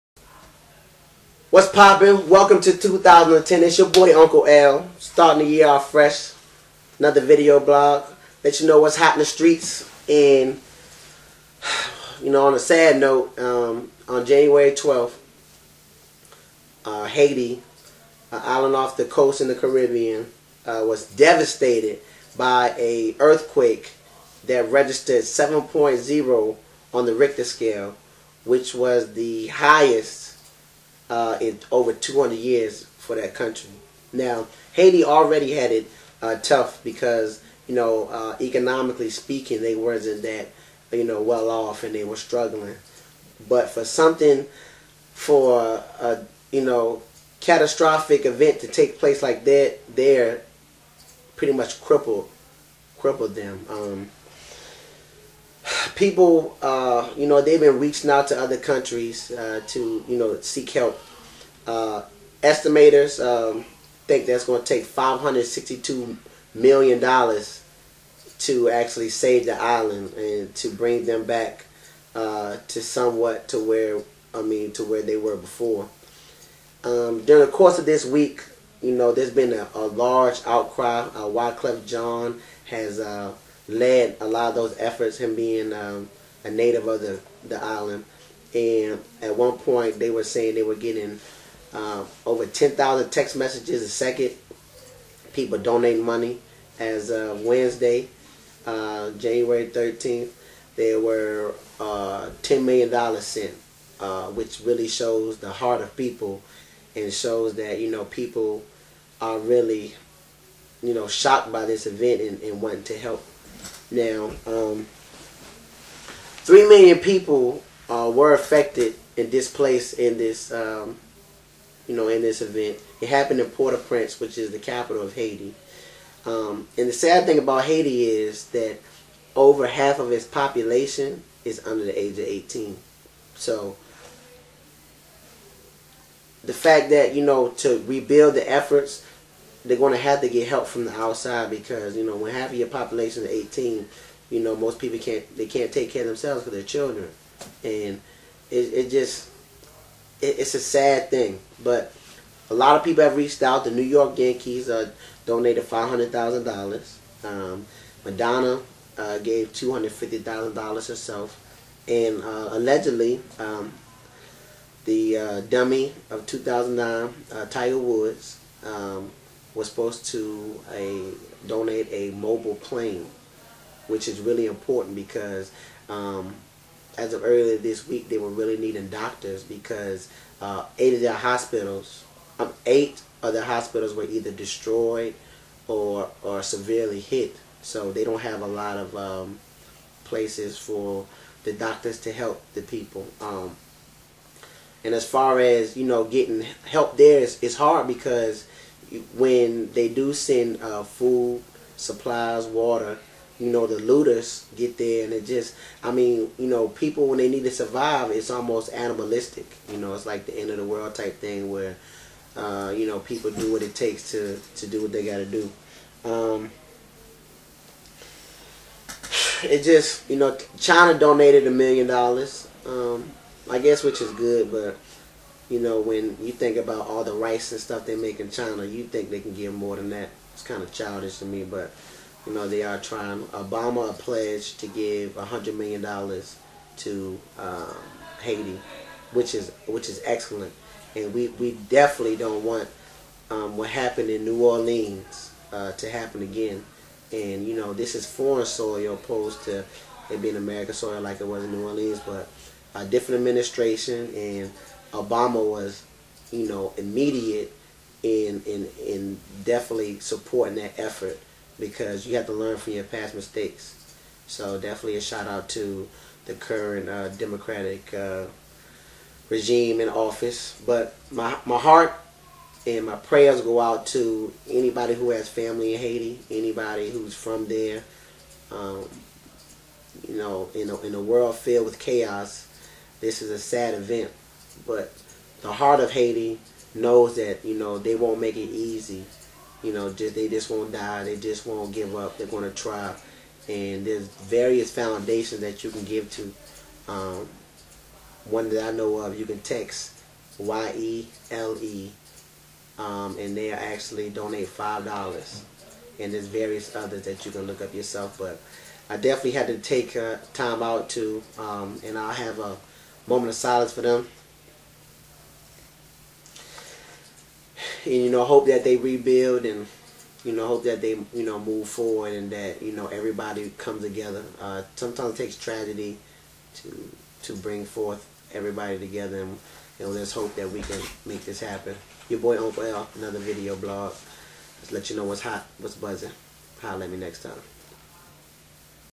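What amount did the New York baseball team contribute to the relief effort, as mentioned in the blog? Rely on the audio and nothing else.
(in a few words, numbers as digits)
$500,000.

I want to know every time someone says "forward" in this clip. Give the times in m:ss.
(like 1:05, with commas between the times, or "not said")
5:21.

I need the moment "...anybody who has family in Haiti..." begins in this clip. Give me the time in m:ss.
4:34.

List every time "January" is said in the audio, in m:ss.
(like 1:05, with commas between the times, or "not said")
0:14, 1:39.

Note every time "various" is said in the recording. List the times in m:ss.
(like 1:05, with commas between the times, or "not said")
4:54, 5:06.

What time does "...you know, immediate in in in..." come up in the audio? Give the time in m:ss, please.
4:16.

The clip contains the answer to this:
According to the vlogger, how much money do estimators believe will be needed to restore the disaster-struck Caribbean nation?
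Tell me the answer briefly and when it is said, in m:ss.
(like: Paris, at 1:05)
$562 million, at 1:04.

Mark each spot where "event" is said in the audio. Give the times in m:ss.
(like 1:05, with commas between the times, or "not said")
0:48, 1:51, 2:02, 4:43.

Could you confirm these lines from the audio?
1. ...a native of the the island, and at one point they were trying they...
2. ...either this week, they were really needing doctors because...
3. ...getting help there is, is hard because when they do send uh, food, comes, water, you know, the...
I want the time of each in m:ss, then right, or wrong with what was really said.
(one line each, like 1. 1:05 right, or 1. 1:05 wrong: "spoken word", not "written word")
1. 1:26 wrong: "saying", not "trying"
2. 2:57 wrong: "earlier", not "either"
3. 3:16 wrong: "supplies", not "comes".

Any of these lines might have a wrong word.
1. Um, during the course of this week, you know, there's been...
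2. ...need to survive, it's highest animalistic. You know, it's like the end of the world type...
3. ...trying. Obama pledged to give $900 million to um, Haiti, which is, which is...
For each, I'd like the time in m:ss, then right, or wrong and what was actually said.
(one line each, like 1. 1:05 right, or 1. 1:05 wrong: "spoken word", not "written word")
1. 1:16 right
2. 3:27 wrong: "almost", not "highest"
3. 3:52 wrong: "100", not "900".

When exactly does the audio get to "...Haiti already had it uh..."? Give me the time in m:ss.
0:34.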